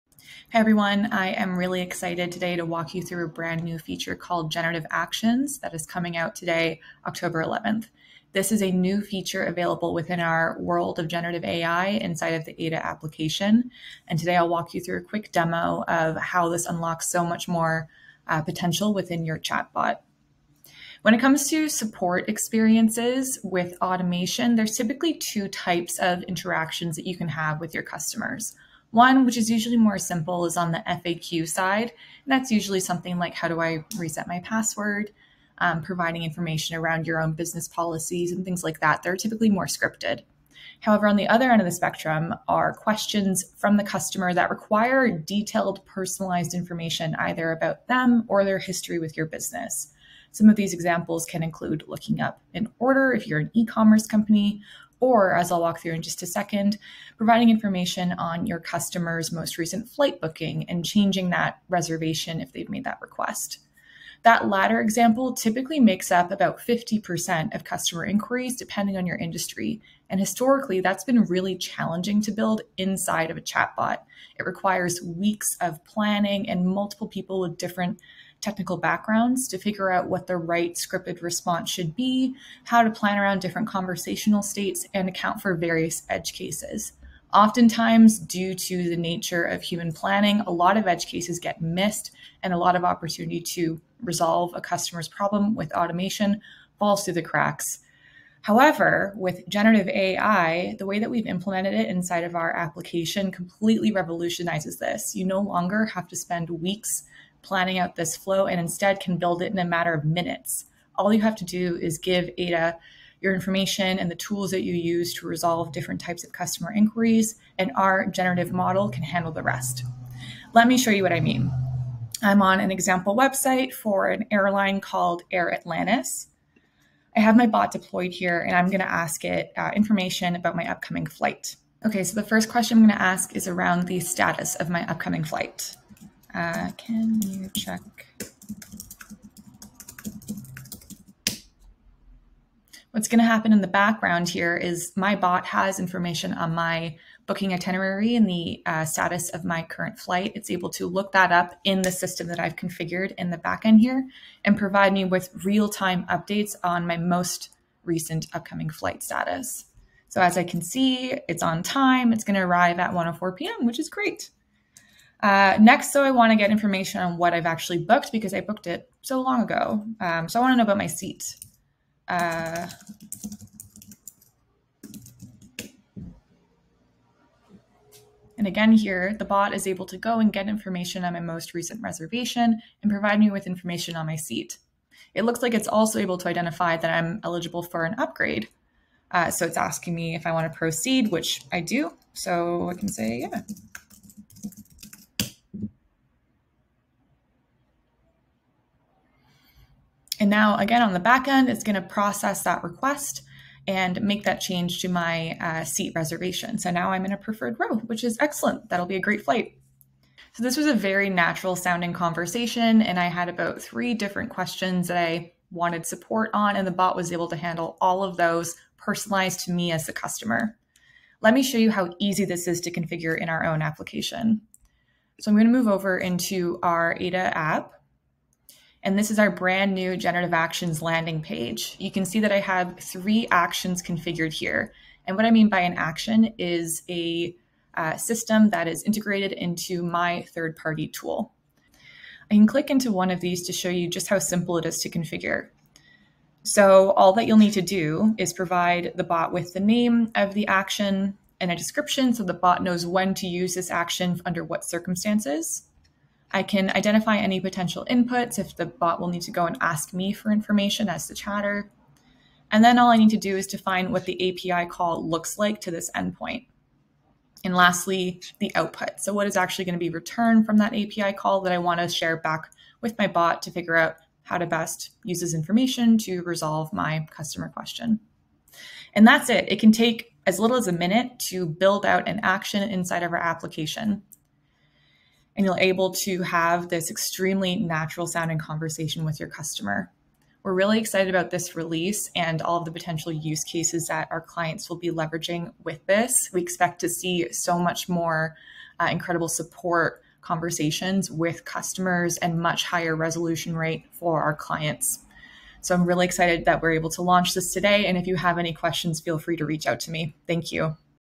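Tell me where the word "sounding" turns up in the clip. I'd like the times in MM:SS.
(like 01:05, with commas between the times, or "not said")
03:31, 04:48.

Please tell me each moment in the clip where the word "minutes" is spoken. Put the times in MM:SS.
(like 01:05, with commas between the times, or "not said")
01:50, 04:40.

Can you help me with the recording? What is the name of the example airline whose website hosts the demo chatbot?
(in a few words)
Air Atlantis.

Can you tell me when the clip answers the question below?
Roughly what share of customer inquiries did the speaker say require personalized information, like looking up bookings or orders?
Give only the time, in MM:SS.
01:06.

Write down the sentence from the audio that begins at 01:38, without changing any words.
However, with generative AI, the way that we've implemented it inside of our application completely revolutionizes this.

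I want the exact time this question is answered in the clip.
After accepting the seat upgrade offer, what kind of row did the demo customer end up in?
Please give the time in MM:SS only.
03:27.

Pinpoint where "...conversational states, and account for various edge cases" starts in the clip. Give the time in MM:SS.
01:23.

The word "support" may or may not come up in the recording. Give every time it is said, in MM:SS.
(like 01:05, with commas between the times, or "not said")
00:21, 03:35, 04:59.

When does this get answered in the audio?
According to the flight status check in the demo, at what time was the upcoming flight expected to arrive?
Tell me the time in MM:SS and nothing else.
02:42.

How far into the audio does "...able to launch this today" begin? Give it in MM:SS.
05:06.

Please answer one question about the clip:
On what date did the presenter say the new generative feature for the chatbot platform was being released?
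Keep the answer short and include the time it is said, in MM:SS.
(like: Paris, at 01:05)
October 11th, at 00:07.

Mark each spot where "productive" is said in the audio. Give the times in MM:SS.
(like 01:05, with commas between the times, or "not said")
not said.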